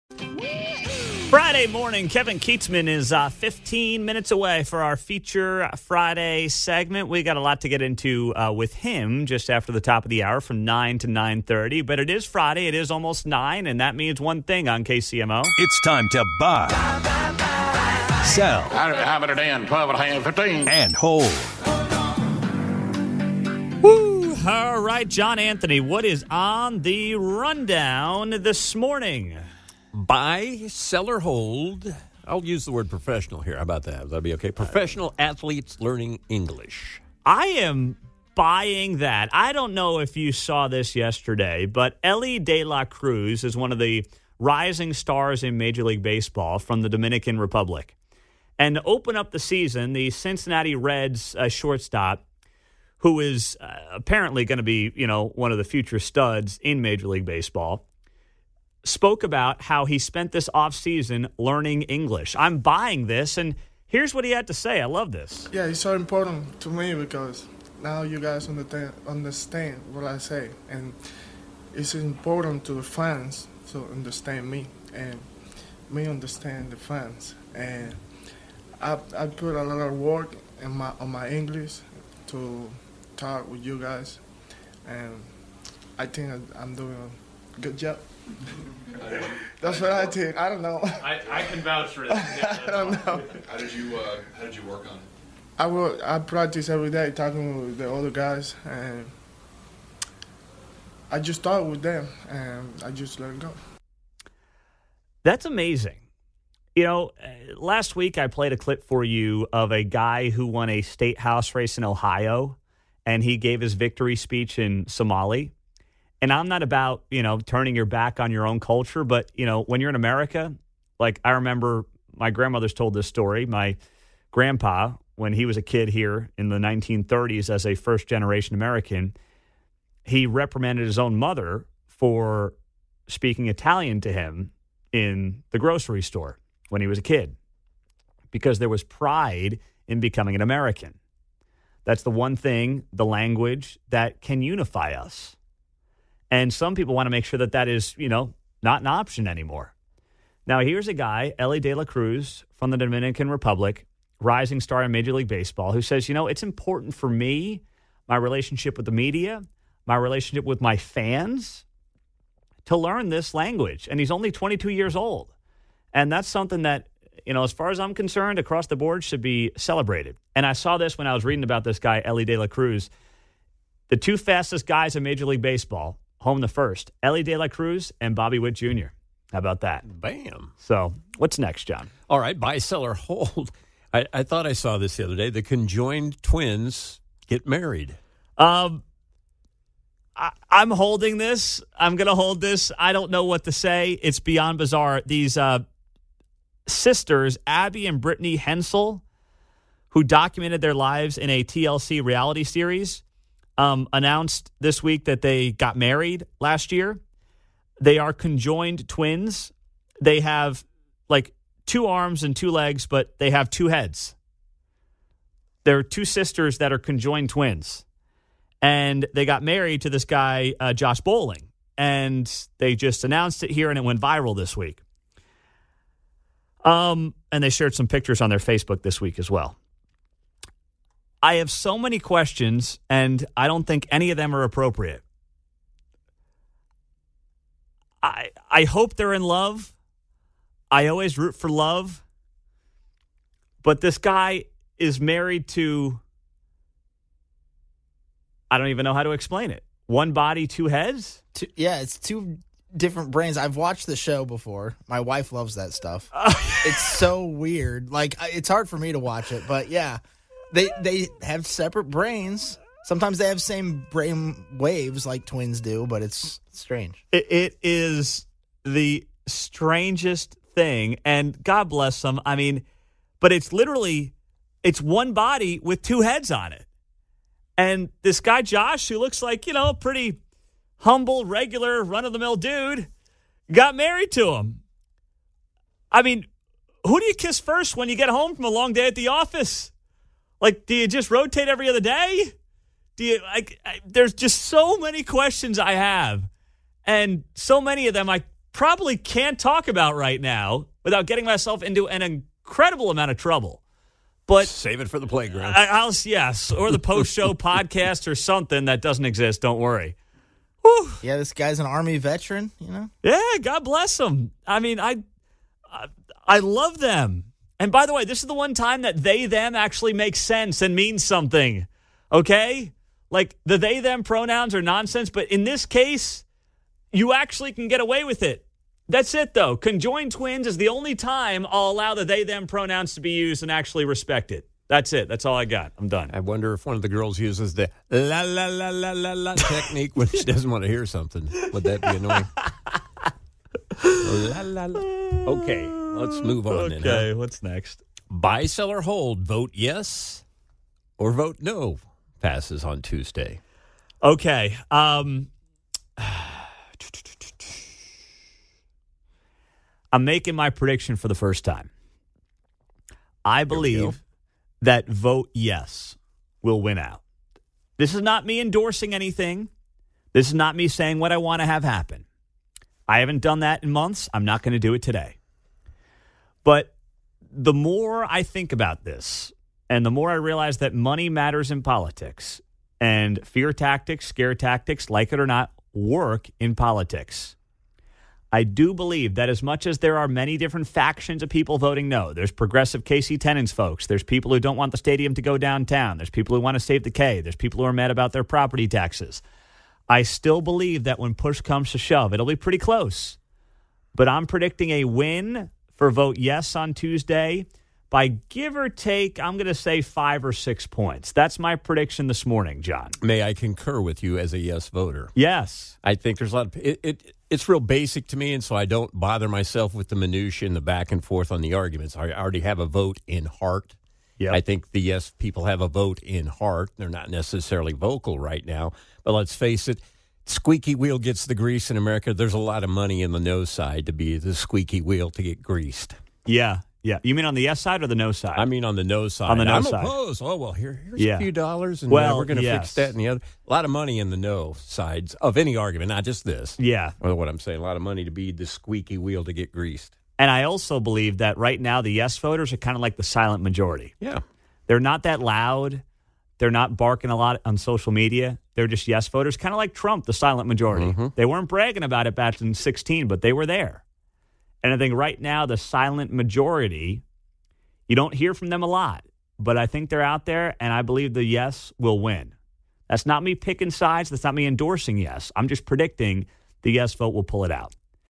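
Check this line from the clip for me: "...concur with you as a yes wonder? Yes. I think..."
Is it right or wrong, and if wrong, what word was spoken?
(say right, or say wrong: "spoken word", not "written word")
wrong: "voter", not "wonder".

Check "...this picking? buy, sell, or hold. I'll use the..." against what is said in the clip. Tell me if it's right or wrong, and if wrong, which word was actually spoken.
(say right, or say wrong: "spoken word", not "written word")
wrong: "morning", not "picking".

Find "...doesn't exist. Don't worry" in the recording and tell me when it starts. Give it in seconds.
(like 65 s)
308 s.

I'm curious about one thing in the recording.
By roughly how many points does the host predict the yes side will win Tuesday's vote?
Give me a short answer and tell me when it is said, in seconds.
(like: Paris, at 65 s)
5 or 6, at 409 s.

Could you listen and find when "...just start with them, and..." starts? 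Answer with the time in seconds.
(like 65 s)
101 s.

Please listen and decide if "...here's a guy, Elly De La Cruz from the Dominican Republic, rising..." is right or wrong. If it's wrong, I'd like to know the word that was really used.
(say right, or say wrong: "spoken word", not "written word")
right.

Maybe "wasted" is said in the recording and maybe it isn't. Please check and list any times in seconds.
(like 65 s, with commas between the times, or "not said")
not said.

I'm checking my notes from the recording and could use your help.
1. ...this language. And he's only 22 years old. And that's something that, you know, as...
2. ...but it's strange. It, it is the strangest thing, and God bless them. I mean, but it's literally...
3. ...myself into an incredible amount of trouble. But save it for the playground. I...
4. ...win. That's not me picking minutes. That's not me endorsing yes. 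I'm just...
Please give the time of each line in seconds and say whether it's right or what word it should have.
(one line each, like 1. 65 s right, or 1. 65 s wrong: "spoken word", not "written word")
1. 163 s right
2. 265 s right
3. 301 s right
4. 471 s wrong: "sides", not "minutes".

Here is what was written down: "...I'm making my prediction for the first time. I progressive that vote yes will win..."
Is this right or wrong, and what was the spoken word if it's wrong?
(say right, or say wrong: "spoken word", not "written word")
wrong: "believe", not "progressive".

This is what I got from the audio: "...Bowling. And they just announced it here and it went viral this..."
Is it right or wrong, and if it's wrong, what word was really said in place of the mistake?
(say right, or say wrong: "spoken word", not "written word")
right.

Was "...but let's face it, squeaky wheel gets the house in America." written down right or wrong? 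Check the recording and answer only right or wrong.
wrong.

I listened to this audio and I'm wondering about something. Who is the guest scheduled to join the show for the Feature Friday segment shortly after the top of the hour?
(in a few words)
Kevin Keatsman.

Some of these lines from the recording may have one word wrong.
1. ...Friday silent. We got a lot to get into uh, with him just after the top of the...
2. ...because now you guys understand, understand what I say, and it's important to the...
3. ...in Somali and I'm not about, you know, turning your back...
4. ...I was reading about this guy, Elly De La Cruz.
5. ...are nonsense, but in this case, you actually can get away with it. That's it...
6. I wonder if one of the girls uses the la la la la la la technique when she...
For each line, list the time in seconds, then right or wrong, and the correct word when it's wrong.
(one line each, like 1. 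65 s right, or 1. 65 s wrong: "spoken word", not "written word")
1. 5 s wrong: "segment", not "silent"
2. 66 s right
3. 114 s right
4. 171 s right
5. 324 s right
6. 336 s right.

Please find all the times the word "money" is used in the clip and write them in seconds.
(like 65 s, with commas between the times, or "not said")
380 s, 432 s, 443 s, 447 s.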